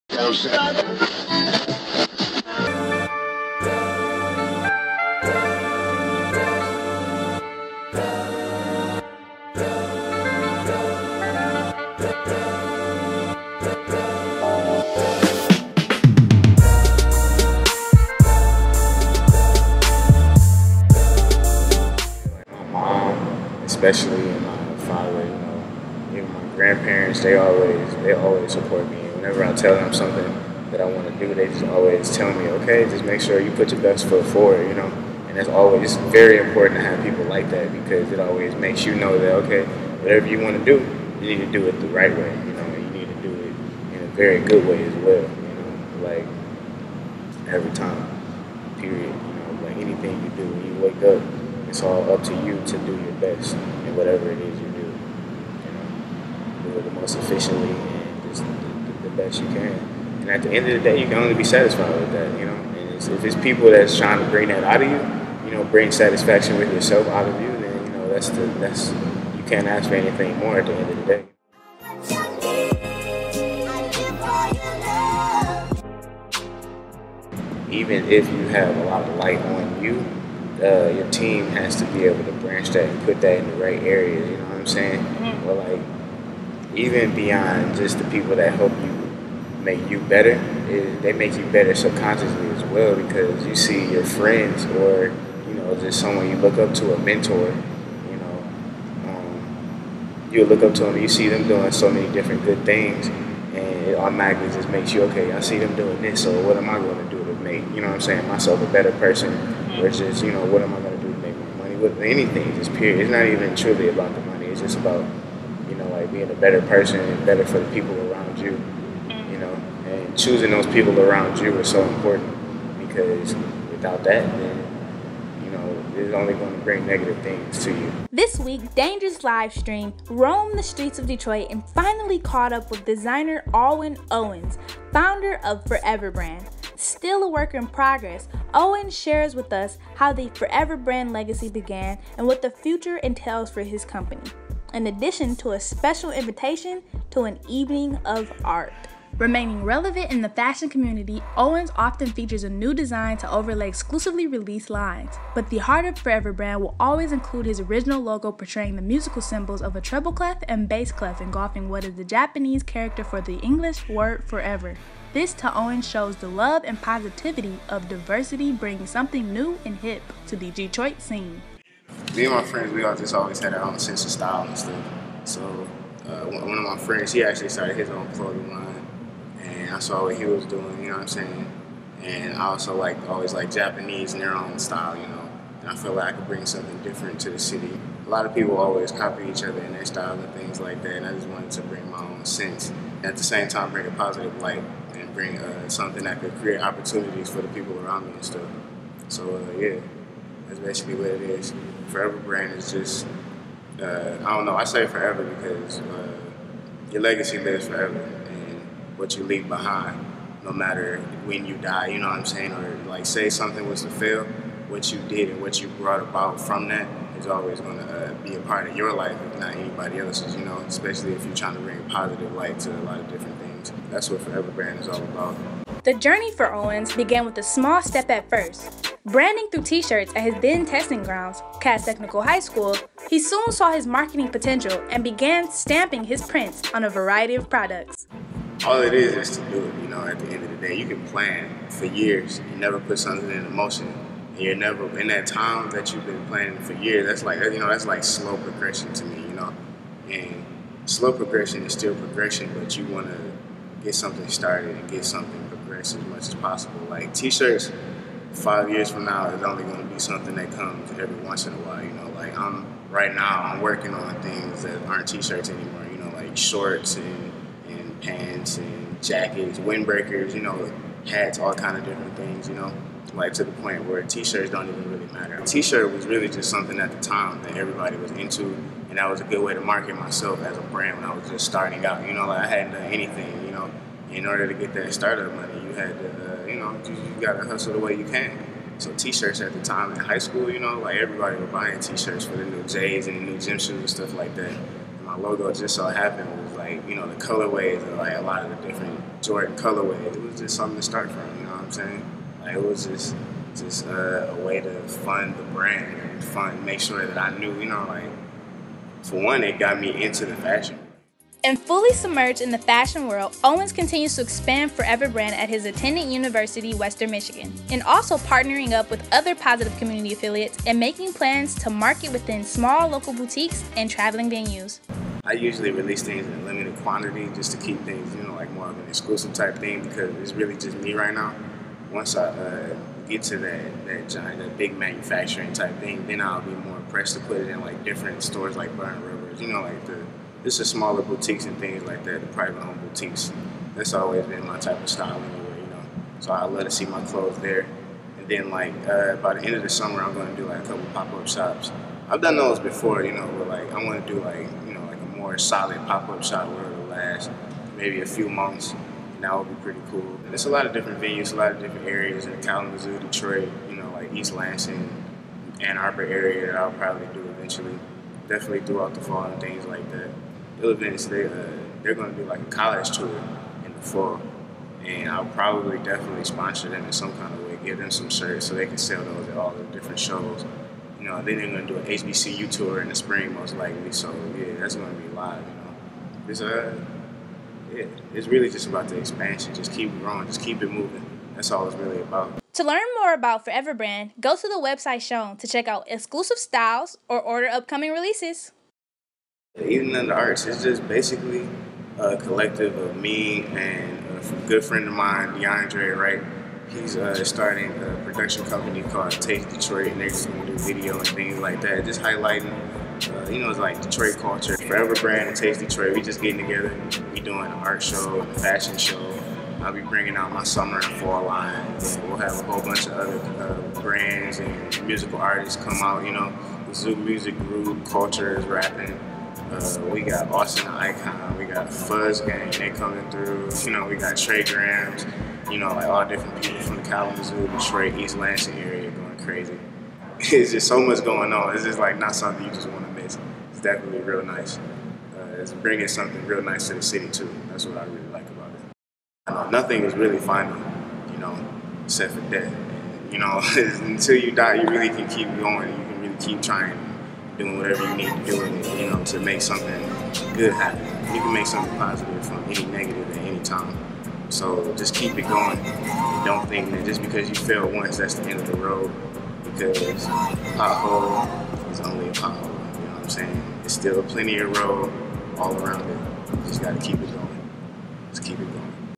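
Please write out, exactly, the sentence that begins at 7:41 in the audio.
You can make something positive from any negative at any time.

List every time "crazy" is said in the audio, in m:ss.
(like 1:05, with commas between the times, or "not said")
7:19.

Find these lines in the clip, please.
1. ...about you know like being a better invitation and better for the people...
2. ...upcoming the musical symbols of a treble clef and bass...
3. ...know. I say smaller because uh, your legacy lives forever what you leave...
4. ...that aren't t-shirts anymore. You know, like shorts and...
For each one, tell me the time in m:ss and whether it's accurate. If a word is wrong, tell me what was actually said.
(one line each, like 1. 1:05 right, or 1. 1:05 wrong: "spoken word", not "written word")
1. 1:54 wrong: "person", not "invitation"
2. 2:38 wrong: "portraying", not "upcoming"
3. 3:24 wrong: "forever", not "smaller"
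4. 4:24 right.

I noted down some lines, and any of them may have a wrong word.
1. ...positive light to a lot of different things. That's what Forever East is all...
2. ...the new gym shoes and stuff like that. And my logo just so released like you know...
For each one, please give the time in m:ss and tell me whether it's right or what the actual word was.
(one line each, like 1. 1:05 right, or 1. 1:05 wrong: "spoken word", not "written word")
1. 3:41 wrong: "Brand", not "East"
2. 4:53 wrong: "happened", not "released".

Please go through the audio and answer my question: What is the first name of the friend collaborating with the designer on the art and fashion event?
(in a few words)
DeAndre.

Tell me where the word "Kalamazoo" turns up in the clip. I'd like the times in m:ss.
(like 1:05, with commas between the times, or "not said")
6:02, 7:16.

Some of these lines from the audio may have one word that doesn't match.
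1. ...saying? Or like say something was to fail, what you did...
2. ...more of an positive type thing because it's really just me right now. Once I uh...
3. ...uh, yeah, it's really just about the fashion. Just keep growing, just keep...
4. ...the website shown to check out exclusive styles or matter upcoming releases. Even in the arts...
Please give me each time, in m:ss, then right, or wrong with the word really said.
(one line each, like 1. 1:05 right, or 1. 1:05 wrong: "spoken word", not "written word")
1. 3:32 right
2. 5:28 wrong: "exclusive", not "positive"
3. 6:26 wrong: "expansion", not "fashion"
4. 6:34 wrong: "order", not "matter".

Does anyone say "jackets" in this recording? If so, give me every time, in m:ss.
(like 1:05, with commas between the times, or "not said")
4:29.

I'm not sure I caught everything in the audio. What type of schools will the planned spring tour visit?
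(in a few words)
HBCU.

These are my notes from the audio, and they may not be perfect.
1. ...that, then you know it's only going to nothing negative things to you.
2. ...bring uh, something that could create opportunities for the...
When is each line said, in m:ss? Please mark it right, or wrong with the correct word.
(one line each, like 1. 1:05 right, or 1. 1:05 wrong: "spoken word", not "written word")
1. 2:04 wrong: "bring", not "nothing"
2. 3:15 right.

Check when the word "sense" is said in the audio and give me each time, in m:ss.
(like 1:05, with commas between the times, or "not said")
2:53, 3:12.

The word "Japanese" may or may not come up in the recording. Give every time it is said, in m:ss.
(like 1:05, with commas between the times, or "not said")
2:42, 3:03.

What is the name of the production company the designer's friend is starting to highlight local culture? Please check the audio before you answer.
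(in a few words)
Take Detroit.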